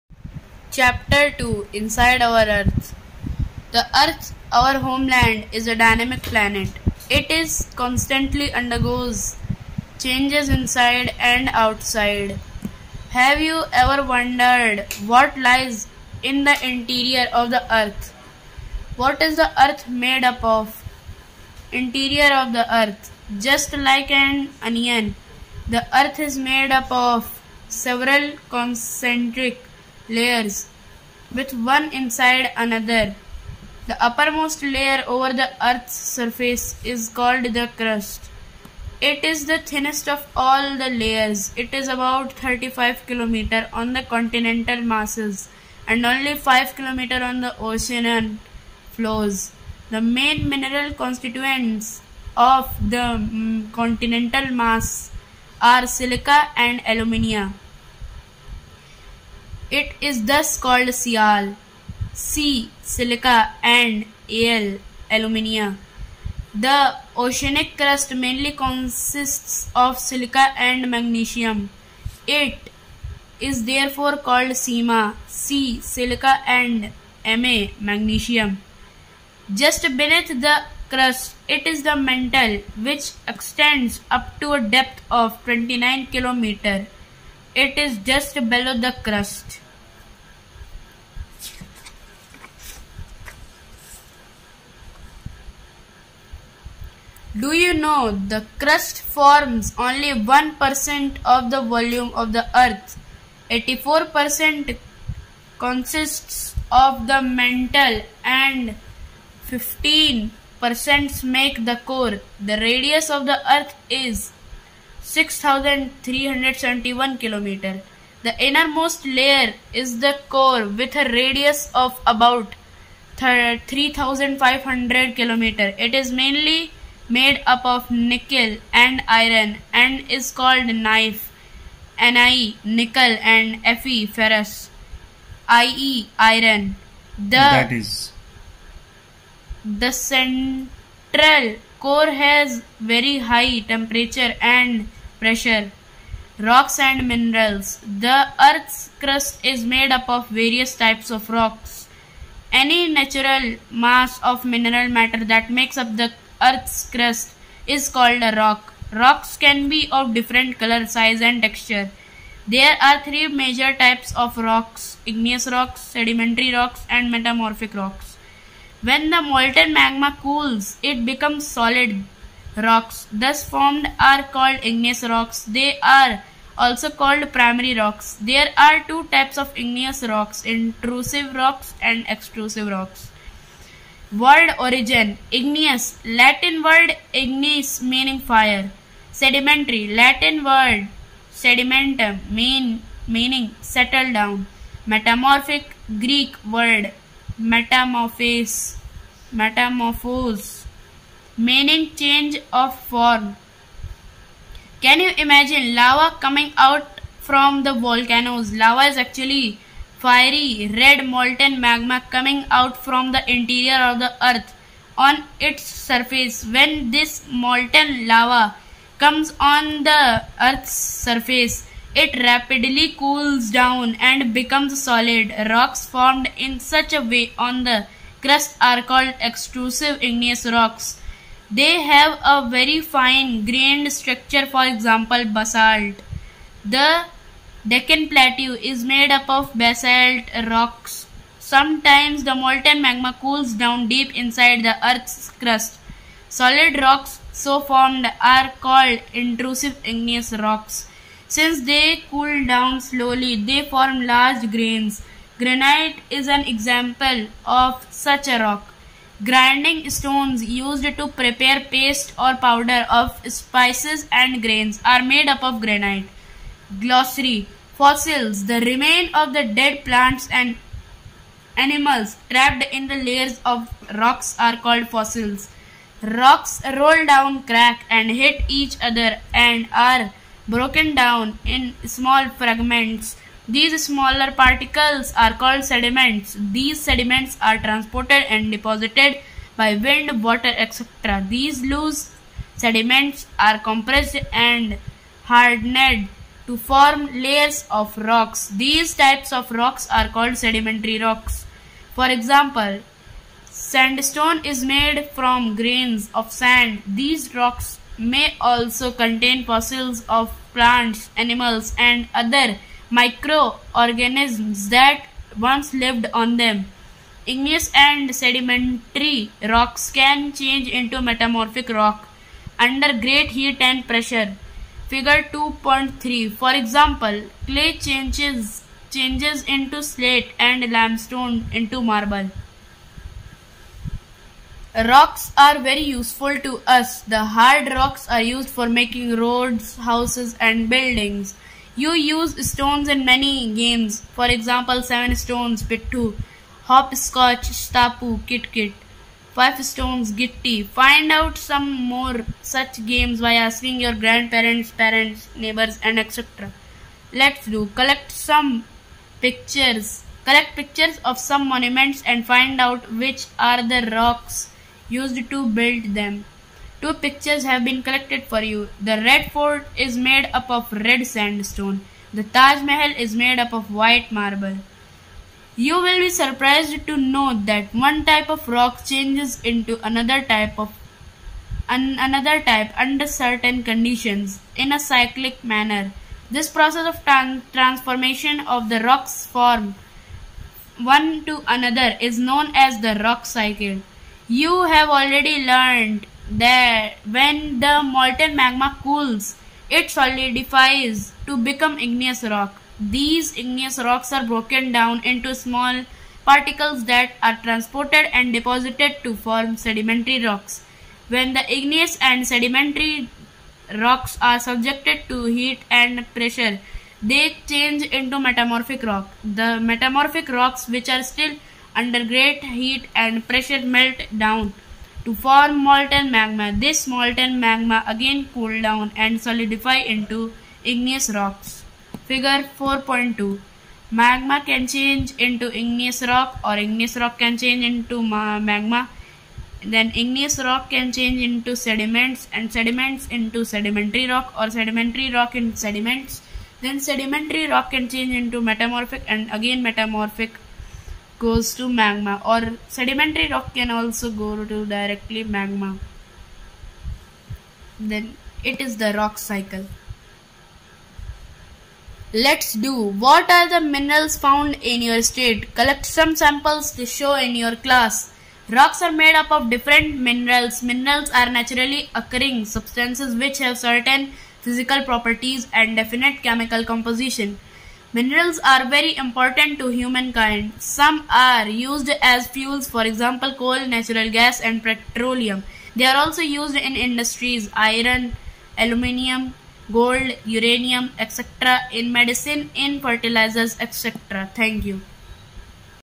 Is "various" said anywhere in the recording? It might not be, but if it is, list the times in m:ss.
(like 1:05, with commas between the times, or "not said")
2:30.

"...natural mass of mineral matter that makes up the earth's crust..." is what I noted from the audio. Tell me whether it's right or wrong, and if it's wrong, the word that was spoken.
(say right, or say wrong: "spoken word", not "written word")
right.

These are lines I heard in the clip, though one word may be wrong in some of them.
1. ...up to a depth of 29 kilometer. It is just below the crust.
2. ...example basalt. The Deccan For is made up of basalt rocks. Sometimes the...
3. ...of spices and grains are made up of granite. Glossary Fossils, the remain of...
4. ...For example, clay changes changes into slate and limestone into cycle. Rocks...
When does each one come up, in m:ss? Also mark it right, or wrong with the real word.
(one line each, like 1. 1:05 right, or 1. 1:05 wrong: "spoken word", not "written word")
1. 1:24 right
2. 3:54 wrong: "Plateau", not "For"
3. 4:22 right
4. 5:26 wrong: "marble", not "cycle".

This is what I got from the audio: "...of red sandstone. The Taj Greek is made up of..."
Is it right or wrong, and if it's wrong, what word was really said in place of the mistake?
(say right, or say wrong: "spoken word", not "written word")
wrong: "Mahal", not "Greek".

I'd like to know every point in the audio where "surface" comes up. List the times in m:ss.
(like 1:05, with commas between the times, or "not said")
0:36, 3:35, 3:40.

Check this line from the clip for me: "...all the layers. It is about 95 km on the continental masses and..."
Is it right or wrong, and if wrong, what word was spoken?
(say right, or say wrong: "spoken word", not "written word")
wrong: "35", not "95".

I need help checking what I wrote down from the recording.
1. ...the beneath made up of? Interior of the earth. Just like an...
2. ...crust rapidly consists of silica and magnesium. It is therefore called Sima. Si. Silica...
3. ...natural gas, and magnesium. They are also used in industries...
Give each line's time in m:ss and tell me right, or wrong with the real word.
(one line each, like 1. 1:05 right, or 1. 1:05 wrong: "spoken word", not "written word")
1. 0:19 wrong: "earth", not "beneath"
2. 1:07 wrong: "mainly", not "rapidly"
3. 8:03 wrong: "petroleum", not "magnesium".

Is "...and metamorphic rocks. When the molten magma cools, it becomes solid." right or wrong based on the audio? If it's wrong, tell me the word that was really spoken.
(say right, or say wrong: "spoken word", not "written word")
right.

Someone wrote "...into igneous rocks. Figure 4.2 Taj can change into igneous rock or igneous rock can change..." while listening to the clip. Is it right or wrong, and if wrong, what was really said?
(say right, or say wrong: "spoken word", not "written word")
wrong: "Magma", not "Taj".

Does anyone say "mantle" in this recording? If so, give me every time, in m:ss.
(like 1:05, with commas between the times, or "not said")
1:21, 1:47.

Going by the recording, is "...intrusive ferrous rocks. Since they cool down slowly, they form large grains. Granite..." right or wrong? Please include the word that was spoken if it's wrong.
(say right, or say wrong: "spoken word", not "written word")
wrong: "igneous", not "ferrous".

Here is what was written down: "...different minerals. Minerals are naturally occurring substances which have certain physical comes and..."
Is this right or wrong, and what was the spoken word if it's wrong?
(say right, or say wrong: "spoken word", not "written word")
wrong: "properties", not "comes".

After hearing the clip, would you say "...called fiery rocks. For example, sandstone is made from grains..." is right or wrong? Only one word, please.
wrong.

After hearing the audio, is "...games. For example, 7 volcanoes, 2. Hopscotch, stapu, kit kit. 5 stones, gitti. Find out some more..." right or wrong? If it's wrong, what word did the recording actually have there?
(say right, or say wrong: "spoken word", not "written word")
wrong: "stones", not "volcanoes".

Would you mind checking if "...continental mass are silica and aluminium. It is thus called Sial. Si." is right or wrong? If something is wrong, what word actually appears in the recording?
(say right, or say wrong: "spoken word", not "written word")
right.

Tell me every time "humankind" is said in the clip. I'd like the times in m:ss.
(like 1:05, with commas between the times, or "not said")
7:59.